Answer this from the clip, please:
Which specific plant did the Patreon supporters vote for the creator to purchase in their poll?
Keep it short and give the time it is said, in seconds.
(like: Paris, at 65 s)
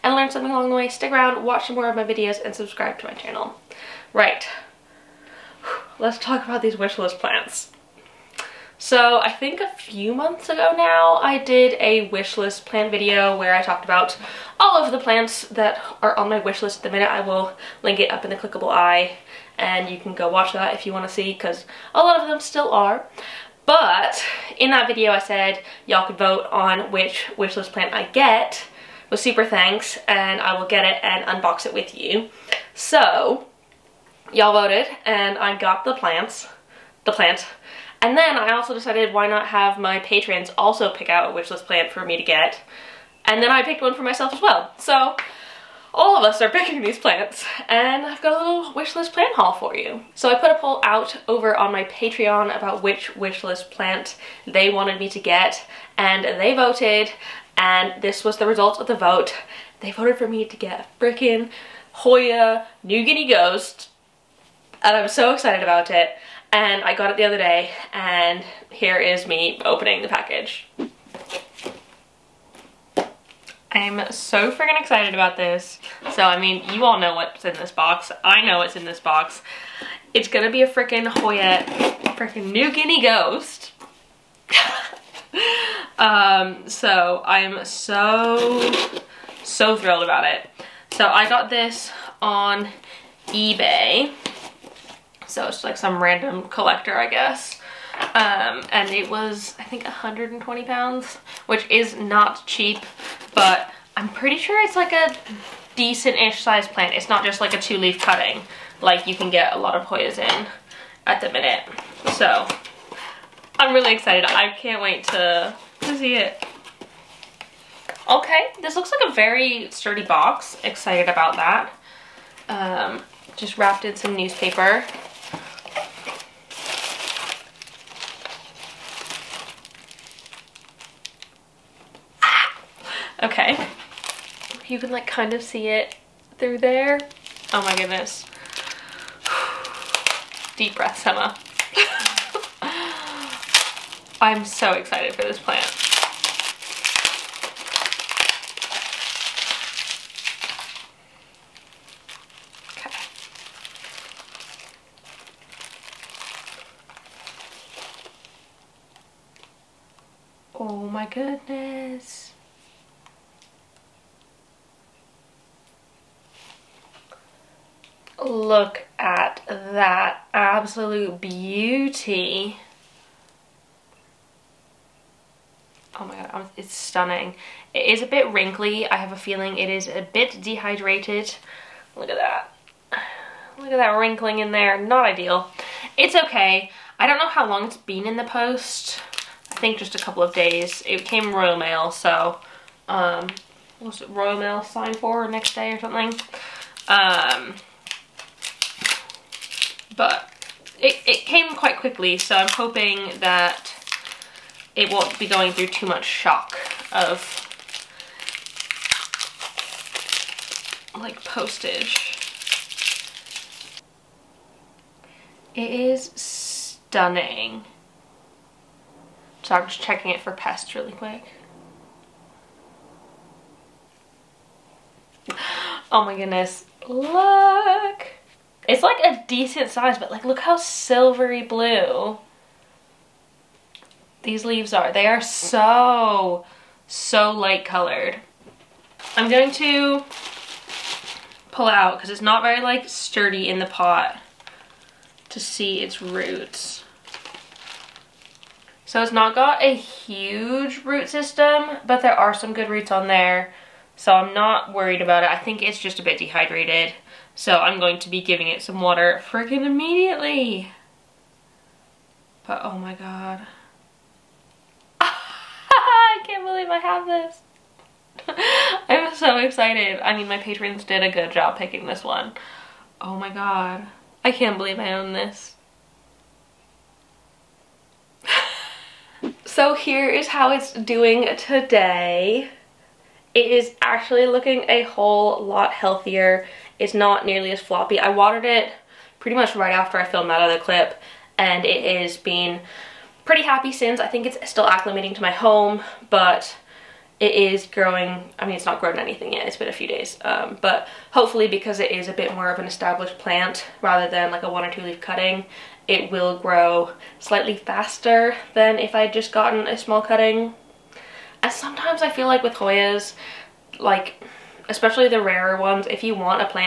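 Hoya New Guinea Ghost, at 61 s.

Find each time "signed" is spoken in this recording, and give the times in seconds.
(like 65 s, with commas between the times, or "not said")
194 s.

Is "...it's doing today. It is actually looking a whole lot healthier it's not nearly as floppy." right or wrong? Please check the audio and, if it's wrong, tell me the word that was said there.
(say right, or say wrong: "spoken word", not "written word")
right.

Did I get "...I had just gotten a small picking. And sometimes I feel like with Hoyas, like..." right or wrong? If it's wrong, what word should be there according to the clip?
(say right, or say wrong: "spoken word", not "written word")
wrong: "cutting", not "picking".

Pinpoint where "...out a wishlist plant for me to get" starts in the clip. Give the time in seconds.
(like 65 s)
41 s.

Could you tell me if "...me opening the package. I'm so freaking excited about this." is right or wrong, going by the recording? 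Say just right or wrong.
right.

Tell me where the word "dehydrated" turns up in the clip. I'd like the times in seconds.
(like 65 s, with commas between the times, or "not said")
180 s, 256 s.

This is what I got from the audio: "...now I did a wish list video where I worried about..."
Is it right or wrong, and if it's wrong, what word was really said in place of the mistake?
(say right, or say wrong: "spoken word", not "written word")
wrong: "talked", not "worried".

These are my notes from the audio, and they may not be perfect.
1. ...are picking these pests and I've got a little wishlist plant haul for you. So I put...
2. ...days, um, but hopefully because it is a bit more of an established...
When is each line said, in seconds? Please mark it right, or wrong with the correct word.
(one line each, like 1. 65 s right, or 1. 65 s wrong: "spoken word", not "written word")
1. 46 s wrong: "plants", not "pests"
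2. 299 s right.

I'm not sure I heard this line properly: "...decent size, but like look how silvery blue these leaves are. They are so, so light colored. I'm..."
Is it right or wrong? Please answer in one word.
right.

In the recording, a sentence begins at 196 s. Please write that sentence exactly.
Um, but it, it came quite quickly, so I'm hoping that it won't be going through too much shock of like postage.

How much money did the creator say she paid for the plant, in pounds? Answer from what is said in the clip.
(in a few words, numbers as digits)
120.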